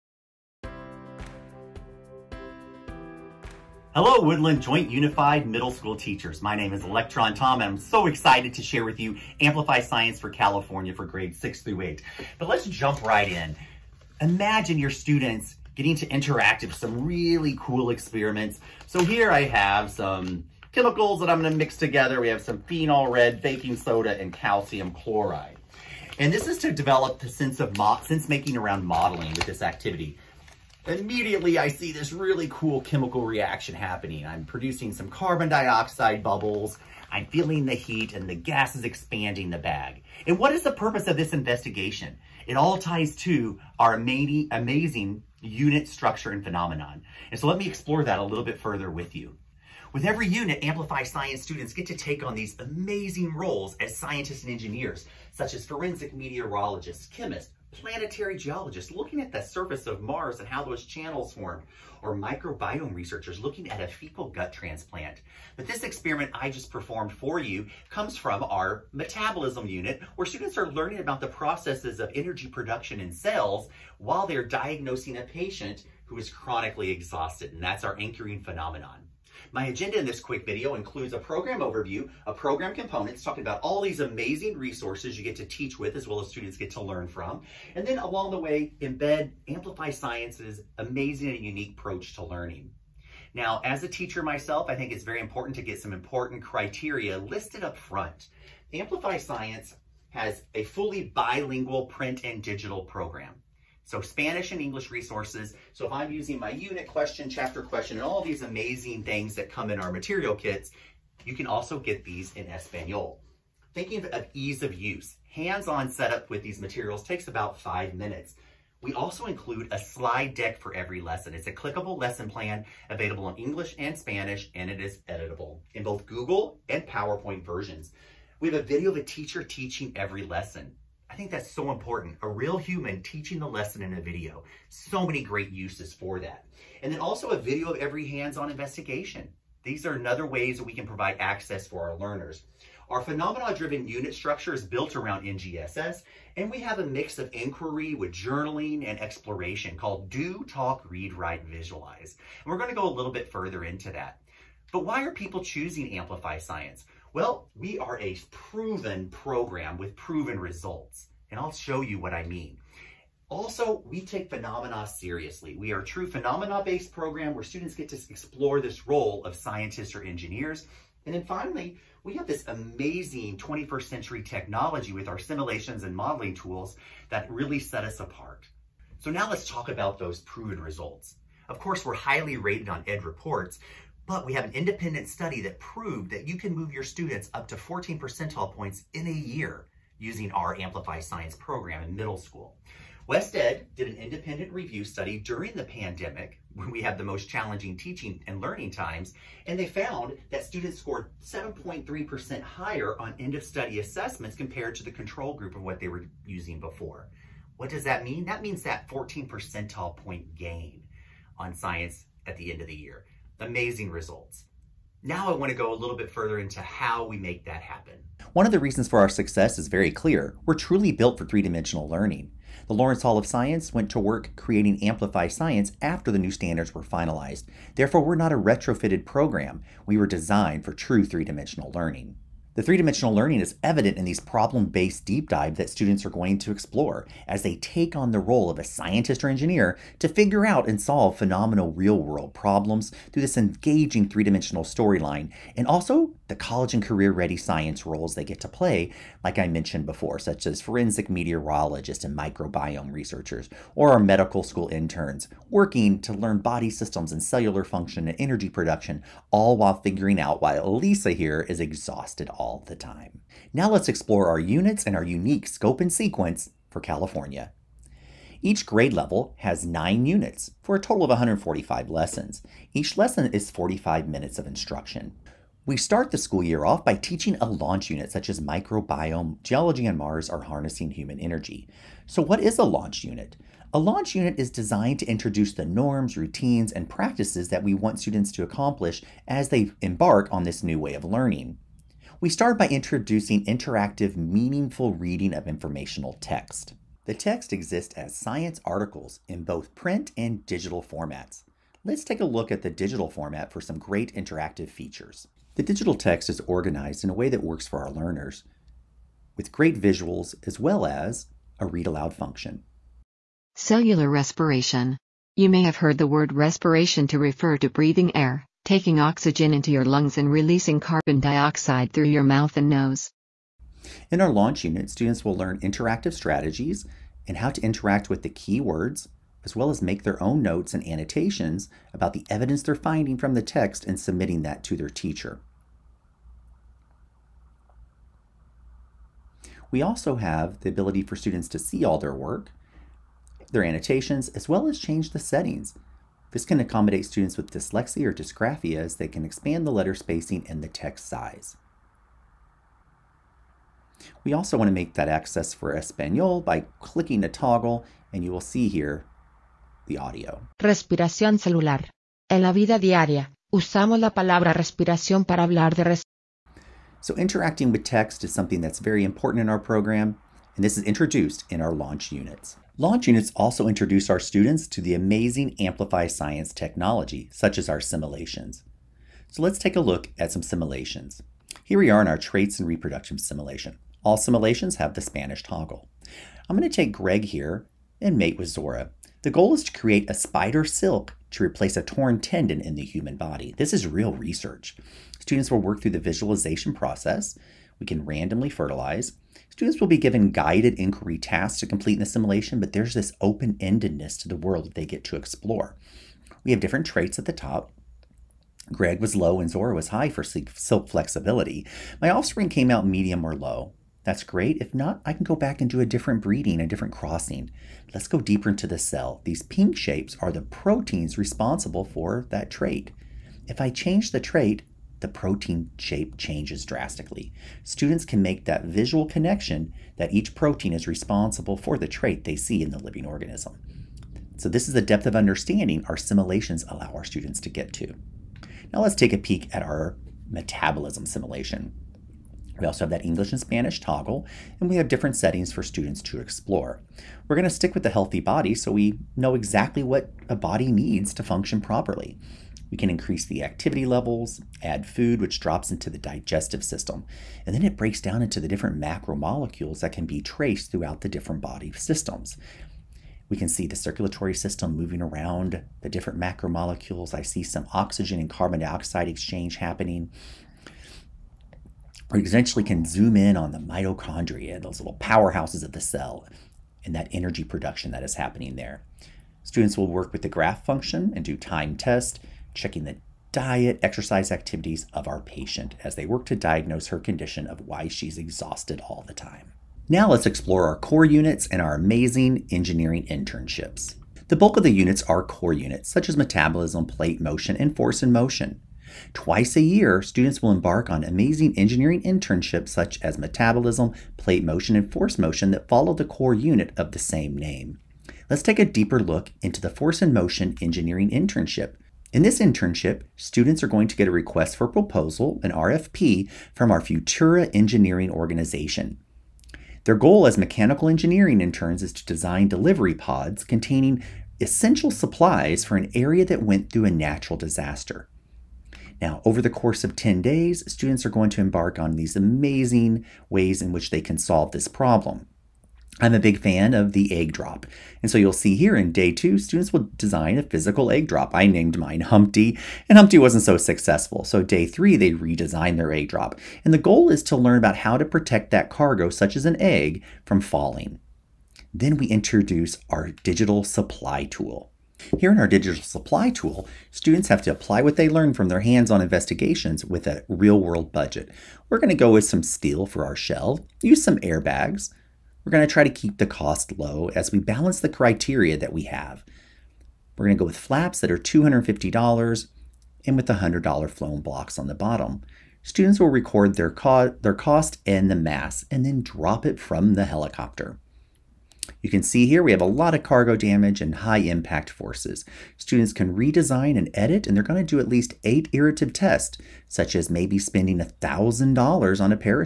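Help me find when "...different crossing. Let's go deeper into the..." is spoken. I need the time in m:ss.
6:56.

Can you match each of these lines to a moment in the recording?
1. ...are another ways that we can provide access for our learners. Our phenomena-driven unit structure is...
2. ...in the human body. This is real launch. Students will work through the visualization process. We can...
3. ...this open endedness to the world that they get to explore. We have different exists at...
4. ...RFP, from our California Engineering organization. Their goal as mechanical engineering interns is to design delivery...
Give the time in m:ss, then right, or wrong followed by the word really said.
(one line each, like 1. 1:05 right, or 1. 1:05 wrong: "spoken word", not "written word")
1. 2:19 right
2. 6:32 wrong: "research", not "launch"
3. 6:42 wrong: "traits", not "exists"
4. 8:35 wrong: "Futura", not "California".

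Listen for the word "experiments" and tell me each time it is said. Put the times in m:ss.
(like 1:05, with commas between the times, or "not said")
0:17, 1:05.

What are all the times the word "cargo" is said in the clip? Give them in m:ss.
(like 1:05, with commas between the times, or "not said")
9:08, 9:43.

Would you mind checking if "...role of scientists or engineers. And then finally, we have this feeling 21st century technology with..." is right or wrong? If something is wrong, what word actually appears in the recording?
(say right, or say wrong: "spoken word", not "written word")
wrong: "amazing", not "feeling".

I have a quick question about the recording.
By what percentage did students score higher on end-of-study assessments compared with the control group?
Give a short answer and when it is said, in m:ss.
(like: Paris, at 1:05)
7.3%, at 3:21.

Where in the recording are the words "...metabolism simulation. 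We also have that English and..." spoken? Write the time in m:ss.
7:20.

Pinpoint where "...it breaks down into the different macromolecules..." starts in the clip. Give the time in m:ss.
7:37.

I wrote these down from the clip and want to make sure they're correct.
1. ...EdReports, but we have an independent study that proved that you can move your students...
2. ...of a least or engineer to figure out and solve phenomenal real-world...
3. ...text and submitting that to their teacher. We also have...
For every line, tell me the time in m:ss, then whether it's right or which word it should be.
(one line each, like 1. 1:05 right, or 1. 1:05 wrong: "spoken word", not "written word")
1. 3:02 right
2. 3:58 wrong: "scientist", not "least"
3. 5:33 right.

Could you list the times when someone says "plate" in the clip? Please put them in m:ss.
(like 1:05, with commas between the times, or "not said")
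8:16, 8:24.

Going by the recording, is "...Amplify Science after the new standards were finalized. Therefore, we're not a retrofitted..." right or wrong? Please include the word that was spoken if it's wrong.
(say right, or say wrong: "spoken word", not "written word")
right.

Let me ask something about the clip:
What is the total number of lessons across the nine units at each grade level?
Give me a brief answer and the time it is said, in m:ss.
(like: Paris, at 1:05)
145, at 4:31.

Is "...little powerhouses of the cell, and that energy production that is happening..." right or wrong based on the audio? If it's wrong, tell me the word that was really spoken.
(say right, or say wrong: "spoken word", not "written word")
right.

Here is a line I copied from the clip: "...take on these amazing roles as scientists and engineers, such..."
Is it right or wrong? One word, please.
right.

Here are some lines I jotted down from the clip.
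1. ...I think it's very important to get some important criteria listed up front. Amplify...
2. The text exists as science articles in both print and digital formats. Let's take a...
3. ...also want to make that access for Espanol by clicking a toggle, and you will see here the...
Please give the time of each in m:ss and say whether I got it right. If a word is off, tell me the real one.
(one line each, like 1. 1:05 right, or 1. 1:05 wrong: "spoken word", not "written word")
1. 1:34 right
2. 4:57 right
3. 5:54 right.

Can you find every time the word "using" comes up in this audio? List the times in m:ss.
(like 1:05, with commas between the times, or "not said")
1:46, 3:09, 3:26.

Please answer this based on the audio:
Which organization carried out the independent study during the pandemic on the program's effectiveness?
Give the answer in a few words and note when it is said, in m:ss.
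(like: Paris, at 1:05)
WestEd, at 3:13.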